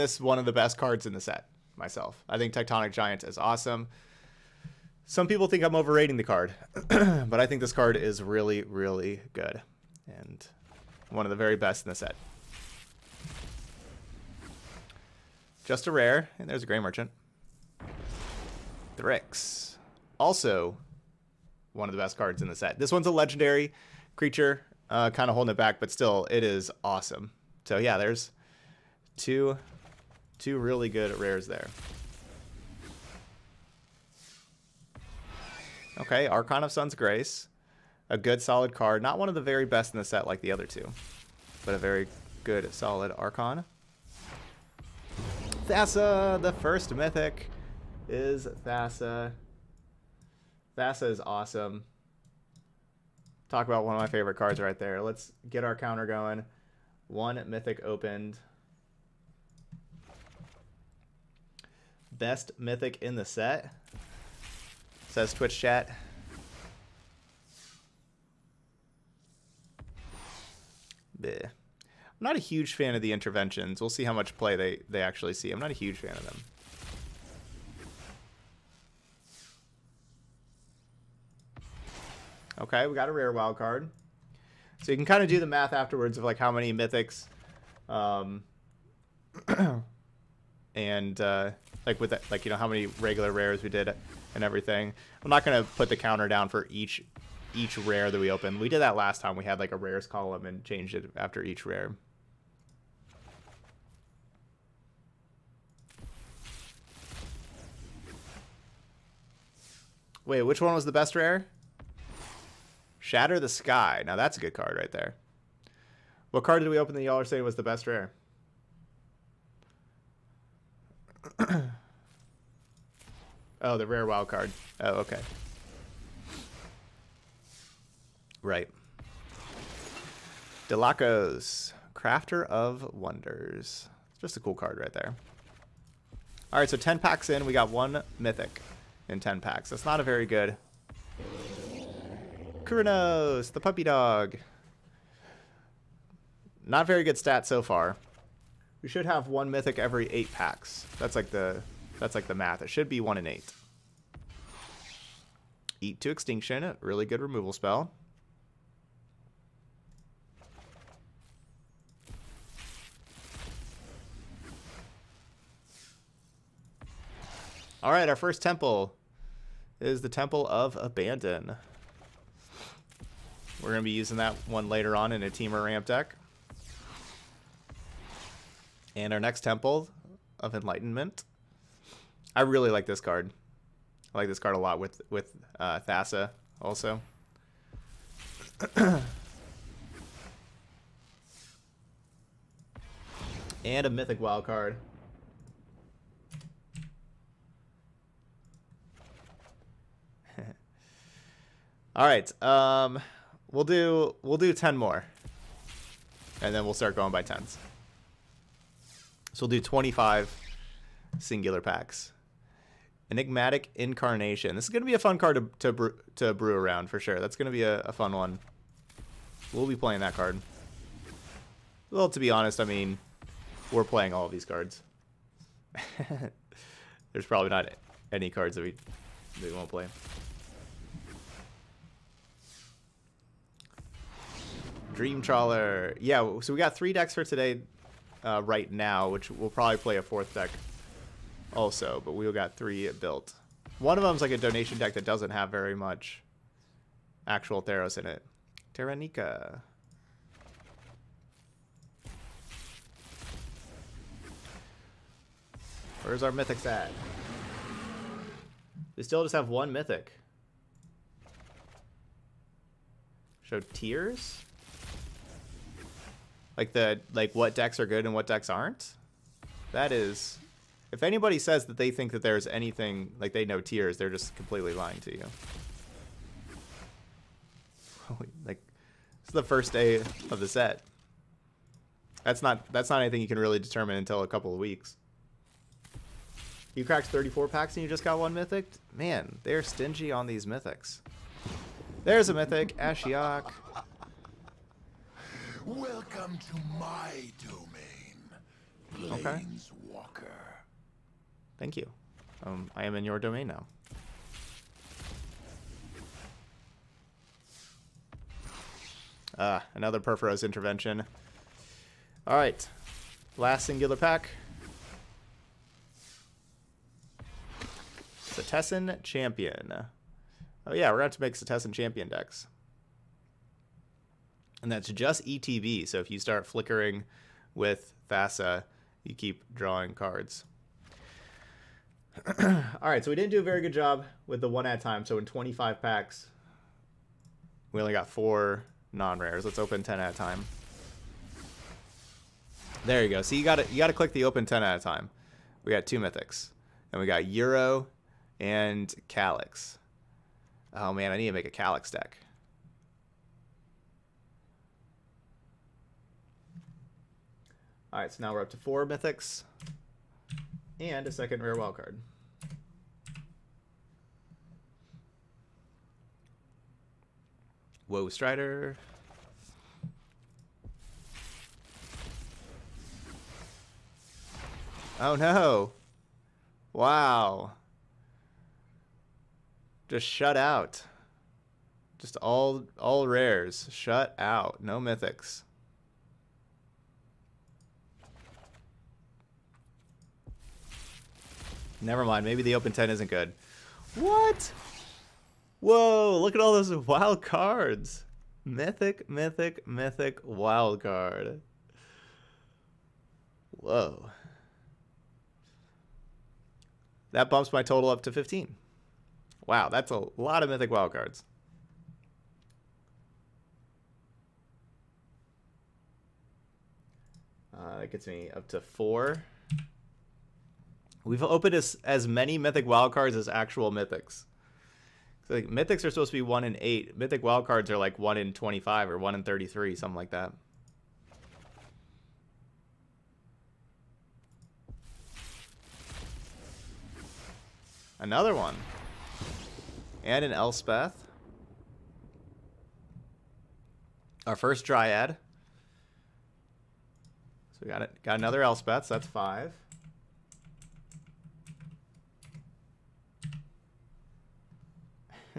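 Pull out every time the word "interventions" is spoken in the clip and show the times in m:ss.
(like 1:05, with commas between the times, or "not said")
1:13, 5:10.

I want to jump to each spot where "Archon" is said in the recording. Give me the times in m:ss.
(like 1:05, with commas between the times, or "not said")
0:36, 0:43.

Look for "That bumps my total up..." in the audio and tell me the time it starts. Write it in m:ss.
6:47.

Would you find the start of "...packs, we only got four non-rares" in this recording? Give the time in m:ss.
5:35.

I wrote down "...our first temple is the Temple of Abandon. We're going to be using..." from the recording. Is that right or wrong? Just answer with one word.
right.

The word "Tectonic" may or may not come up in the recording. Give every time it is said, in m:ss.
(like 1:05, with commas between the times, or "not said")
0:02.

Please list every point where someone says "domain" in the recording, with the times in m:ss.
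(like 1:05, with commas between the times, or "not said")
4:57, 5:03.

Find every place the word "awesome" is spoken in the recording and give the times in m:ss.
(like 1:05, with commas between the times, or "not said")
0:03, 0:26, 0:51.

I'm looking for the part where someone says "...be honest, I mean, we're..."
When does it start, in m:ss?
3:42.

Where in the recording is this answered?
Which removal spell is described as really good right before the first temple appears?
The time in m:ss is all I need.
2:35.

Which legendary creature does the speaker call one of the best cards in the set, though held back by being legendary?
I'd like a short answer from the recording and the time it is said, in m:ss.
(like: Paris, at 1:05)
Thryx, at 0:18.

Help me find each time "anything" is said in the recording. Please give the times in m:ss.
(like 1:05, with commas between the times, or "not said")
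4:32, 4:43.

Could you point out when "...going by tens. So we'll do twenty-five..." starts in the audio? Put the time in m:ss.
3:26.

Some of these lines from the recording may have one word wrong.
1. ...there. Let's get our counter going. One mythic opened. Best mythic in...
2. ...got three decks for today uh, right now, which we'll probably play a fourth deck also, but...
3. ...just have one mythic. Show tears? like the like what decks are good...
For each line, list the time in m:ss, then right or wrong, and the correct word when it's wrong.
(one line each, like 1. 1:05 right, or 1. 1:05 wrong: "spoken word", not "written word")
1. 0:54 right
2. 3:56 right
3. 4:19 right.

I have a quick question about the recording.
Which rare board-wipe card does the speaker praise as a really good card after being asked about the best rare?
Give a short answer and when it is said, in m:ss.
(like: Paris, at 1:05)
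Shatter the Sky, at 1:52.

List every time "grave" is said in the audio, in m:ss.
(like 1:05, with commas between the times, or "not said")
not said.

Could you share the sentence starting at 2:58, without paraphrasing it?
And our next Temple of Enlightenment.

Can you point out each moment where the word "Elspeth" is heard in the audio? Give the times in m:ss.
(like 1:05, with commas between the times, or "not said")
7:20, 7:28.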